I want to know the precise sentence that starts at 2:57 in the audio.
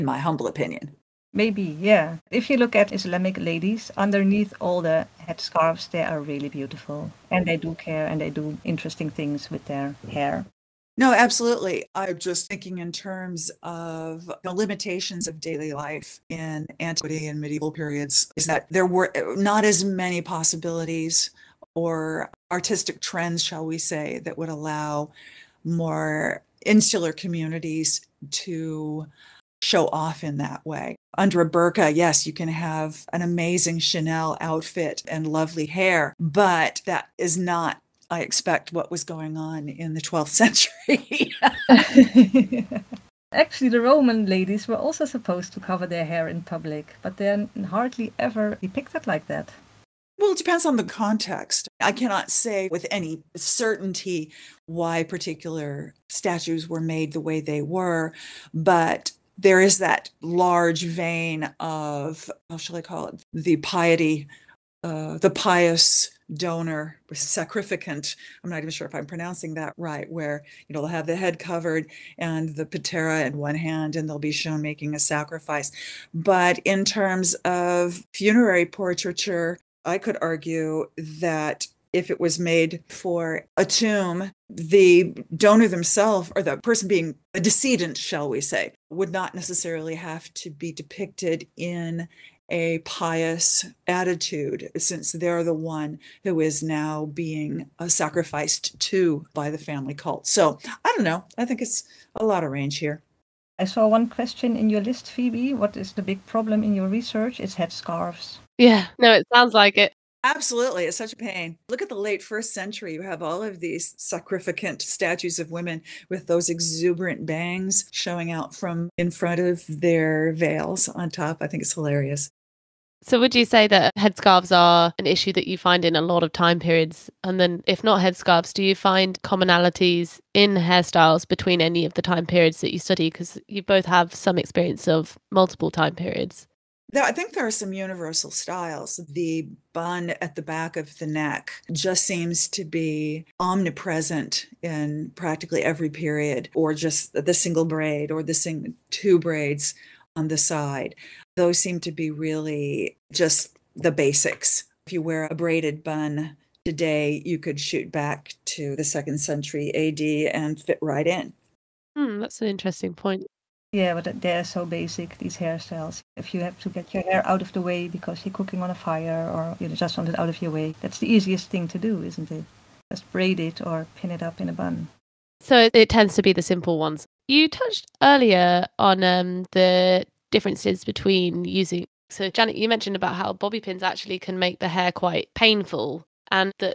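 You touched earlier on um, the differences between using.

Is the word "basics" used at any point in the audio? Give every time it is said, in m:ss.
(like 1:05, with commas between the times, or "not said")
2:33, 2:44.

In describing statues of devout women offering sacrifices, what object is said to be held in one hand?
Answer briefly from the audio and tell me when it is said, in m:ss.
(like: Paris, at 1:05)
patera, at 1:12.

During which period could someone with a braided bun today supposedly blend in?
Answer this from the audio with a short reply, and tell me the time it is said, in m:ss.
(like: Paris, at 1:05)
second century AD, at 2:38.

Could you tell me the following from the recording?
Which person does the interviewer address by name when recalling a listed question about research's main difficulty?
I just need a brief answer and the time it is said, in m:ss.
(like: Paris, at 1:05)
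Phoebe, at 1:45.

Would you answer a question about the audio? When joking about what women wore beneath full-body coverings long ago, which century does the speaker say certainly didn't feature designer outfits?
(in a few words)
12th century.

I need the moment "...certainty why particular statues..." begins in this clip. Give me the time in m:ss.
0:53.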